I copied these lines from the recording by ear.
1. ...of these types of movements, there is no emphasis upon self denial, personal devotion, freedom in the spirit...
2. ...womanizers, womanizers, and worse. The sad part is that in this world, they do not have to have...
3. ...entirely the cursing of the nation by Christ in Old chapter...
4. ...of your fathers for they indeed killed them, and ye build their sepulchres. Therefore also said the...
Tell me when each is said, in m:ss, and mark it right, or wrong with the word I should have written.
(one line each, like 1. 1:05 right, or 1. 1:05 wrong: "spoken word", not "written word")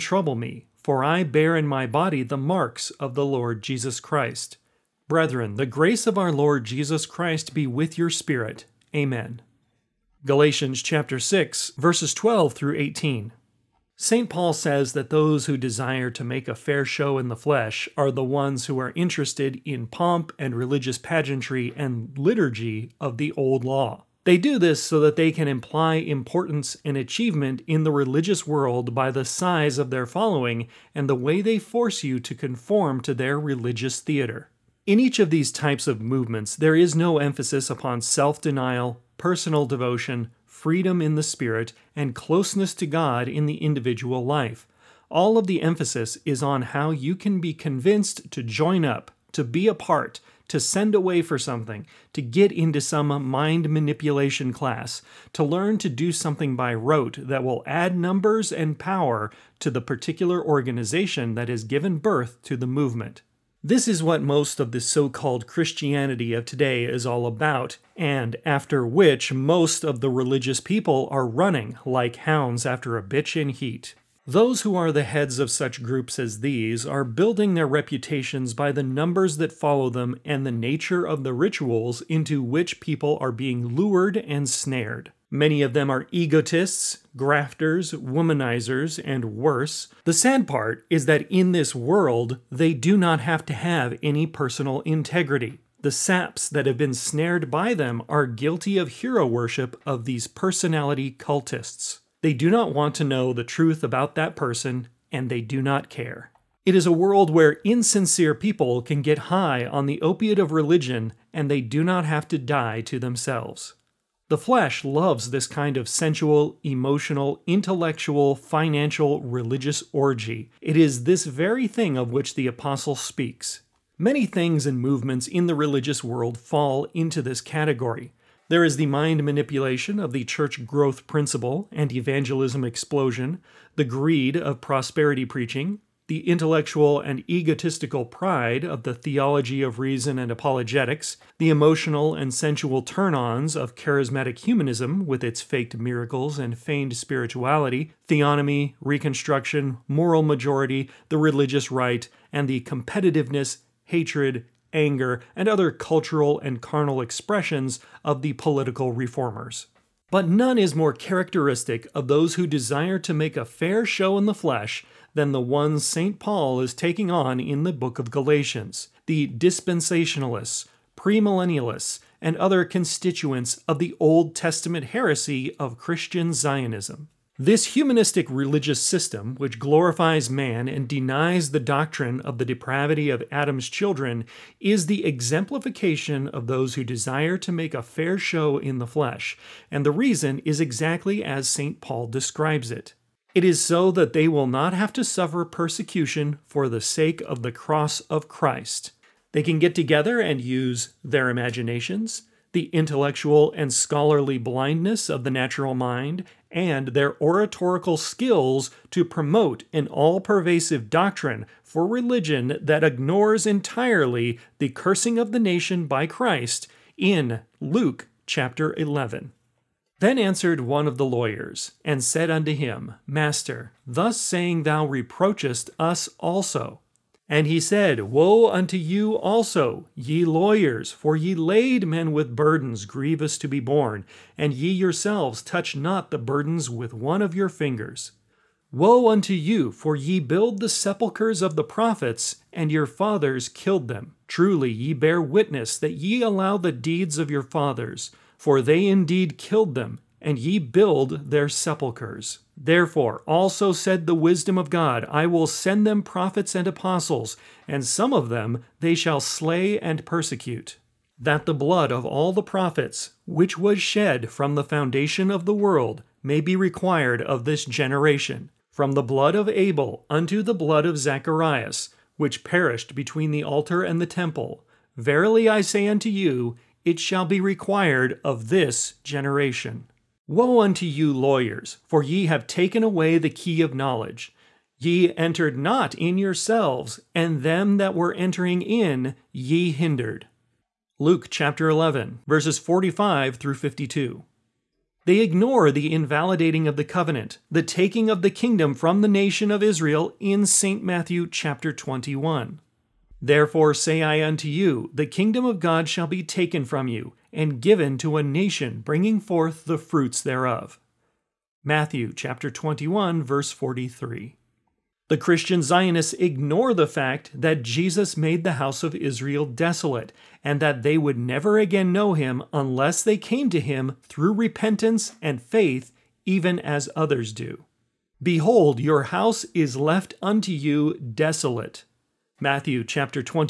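1. 0:35 right
2. 1:27 wrong: "grafters", not "womanizers"
3. 3:33 wrong: "Luke", not "Old"
4. 4:07 right.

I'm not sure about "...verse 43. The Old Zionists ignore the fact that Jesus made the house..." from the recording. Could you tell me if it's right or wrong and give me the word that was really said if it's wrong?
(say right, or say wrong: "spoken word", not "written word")
wrong: "Christian", not "Old".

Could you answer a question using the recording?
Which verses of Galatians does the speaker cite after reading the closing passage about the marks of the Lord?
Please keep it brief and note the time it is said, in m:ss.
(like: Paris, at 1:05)
Chapter 6, verses 12-18, at 0:10.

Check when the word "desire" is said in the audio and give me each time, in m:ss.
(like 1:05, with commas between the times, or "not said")
0:15, 2:42, 3:06.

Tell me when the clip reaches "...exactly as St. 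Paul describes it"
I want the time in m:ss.
3:10.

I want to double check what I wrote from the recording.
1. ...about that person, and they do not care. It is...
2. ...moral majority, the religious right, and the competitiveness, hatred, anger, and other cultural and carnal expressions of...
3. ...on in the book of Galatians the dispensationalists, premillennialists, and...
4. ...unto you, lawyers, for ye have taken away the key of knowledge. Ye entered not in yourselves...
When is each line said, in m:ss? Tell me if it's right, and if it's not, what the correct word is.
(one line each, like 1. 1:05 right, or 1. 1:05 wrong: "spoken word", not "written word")
1. 1:43 right
2. 2:29 right
3. 2:47 right
4. 4:40 right.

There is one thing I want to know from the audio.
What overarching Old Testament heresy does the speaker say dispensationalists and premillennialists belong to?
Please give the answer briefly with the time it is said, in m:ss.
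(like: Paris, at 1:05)
Christian Zionism, at 2:55.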